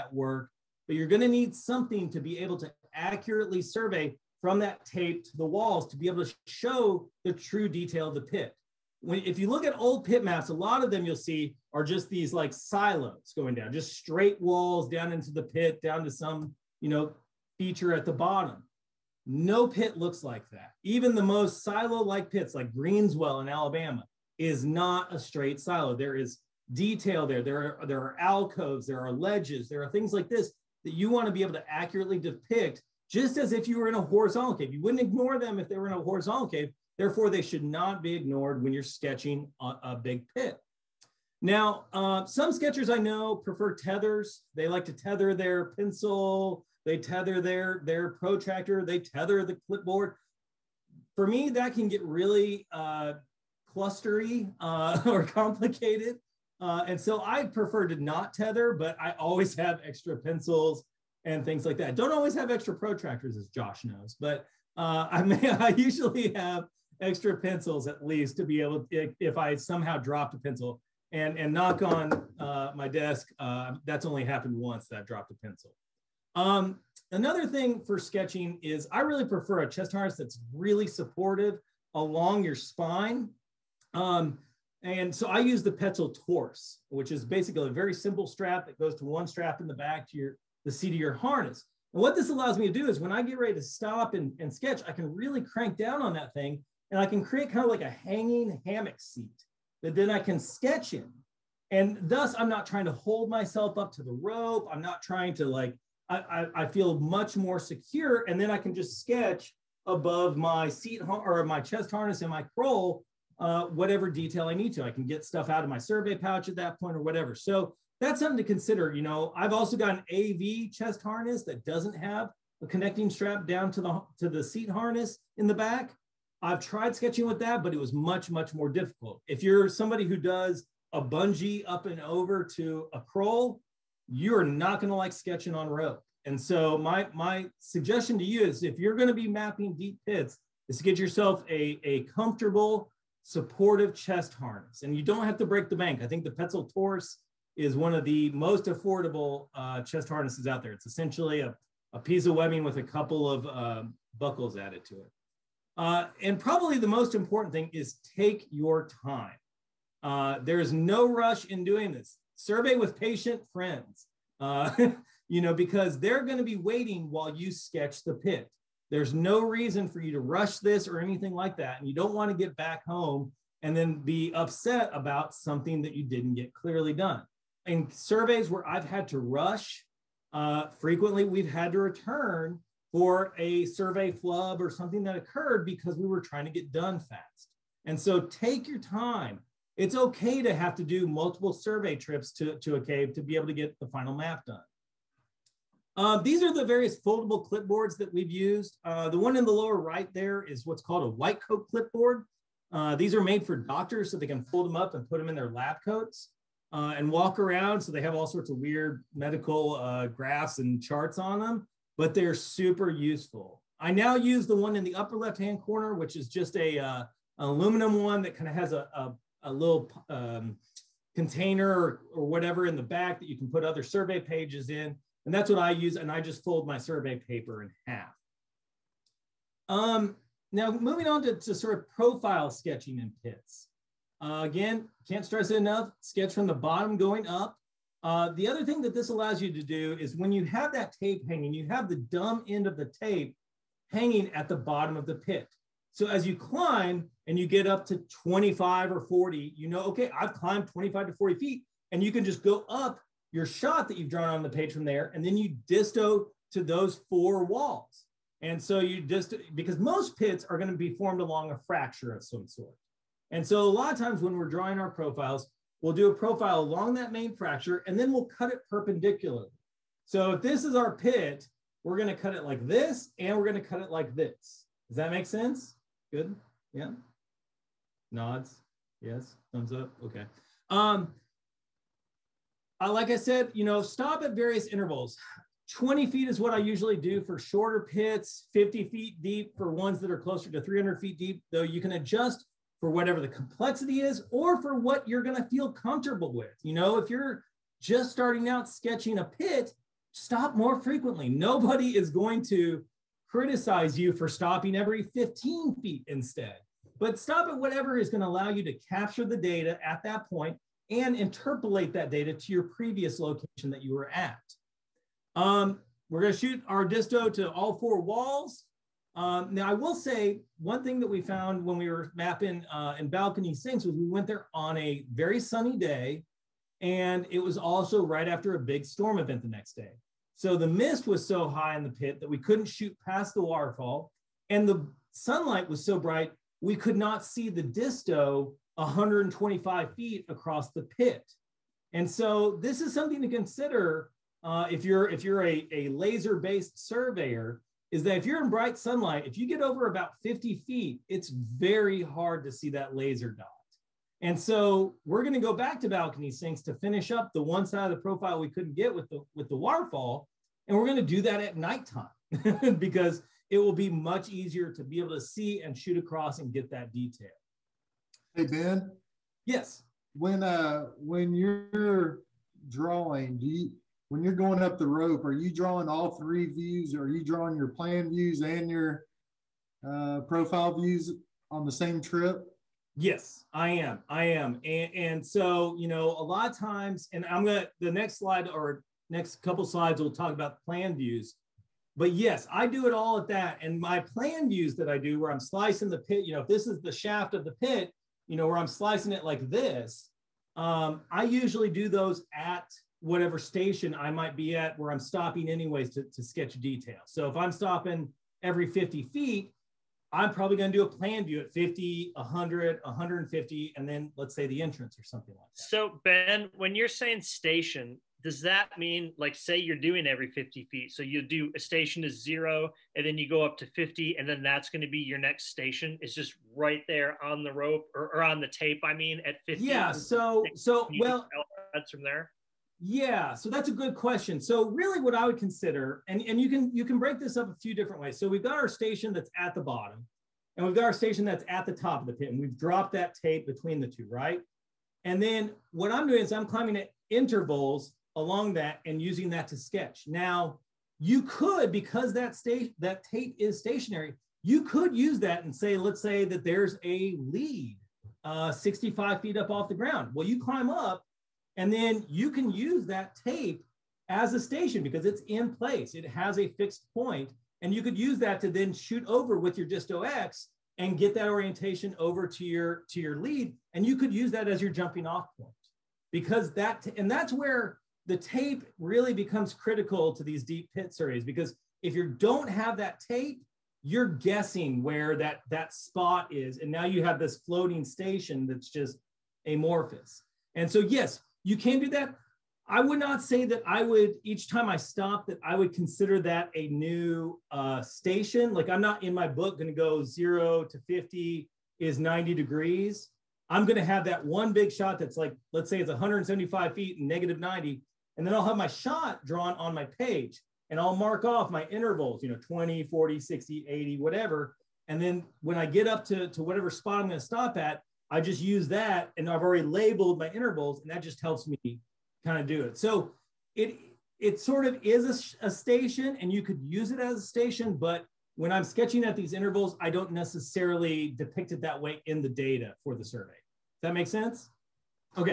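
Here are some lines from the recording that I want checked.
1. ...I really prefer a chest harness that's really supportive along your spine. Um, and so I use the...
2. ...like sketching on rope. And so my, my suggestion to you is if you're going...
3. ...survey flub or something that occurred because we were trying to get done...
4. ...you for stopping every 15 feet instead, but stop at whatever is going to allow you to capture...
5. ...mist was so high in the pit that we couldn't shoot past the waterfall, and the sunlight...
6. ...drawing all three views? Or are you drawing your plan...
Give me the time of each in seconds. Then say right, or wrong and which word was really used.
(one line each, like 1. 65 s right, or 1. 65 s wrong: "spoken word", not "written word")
1. 78 s right
2. 134 s right
3. 183 s right
4. 303 s right
5. 330 s right
6. 375 s right.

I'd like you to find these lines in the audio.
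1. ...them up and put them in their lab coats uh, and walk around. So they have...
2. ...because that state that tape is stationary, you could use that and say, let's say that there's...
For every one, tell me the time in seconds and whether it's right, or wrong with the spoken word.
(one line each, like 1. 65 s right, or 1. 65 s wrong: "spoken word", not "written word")
1. 204 s right
2. 451 s right.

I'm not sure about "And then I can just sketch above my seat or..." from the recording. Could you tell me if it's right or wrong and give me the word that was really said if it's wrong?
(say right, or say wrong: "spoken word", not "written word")
right.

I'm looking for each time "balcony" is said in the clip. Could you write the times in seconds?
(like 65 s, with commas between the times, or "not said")
323 s, 355 s.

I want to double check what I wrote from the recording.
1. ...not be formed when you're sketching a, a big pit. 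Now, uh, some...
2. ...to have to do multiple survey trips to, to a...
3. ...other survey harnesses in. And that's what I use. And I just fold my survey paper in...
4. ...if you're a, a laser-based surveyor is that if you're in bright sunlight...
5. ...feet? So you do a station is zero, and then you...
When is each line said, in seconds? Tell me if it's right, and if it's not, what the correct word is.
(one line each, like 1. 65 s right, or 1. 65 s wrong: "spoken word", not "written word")
1. 37 s wrong: "ignored", not "formed"
2. 190 s right
3. 223 s wrong: "pages", not "harnesses"
4. 345 s right
5. 420 s right.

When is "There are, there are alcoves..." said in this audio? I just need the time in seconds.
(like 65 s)
27 s.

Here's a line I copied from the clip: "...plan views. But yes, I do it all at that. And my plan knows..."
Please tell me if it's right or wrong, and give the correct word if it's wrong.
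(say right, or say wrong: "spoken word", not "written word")
wrong: "views", not "knows".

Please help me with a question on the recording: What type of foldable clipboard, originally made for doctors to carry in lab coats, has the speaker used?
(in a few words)
white coat clipboard.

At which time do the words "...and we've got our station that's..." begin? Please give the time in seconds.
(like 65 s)
440 s.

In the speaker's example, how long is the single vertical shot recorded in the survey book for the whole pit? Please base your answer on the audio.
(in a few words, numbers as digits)
175 feet.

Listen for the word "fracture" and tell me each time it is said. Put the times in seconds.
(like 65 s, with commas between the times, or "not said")
261 s, 267 s.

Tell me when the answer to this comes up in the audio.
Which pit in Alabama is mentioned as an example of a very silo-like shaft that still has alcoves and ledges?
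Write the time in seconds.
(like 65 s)
22 s.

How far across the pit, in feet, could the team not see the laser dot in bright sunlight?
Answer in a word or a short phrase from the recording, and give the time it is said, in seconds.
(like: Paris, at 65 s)
125 feet, at 338 s.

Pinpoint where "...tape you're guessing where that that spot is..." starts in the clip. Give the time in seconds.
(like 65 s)
483 s.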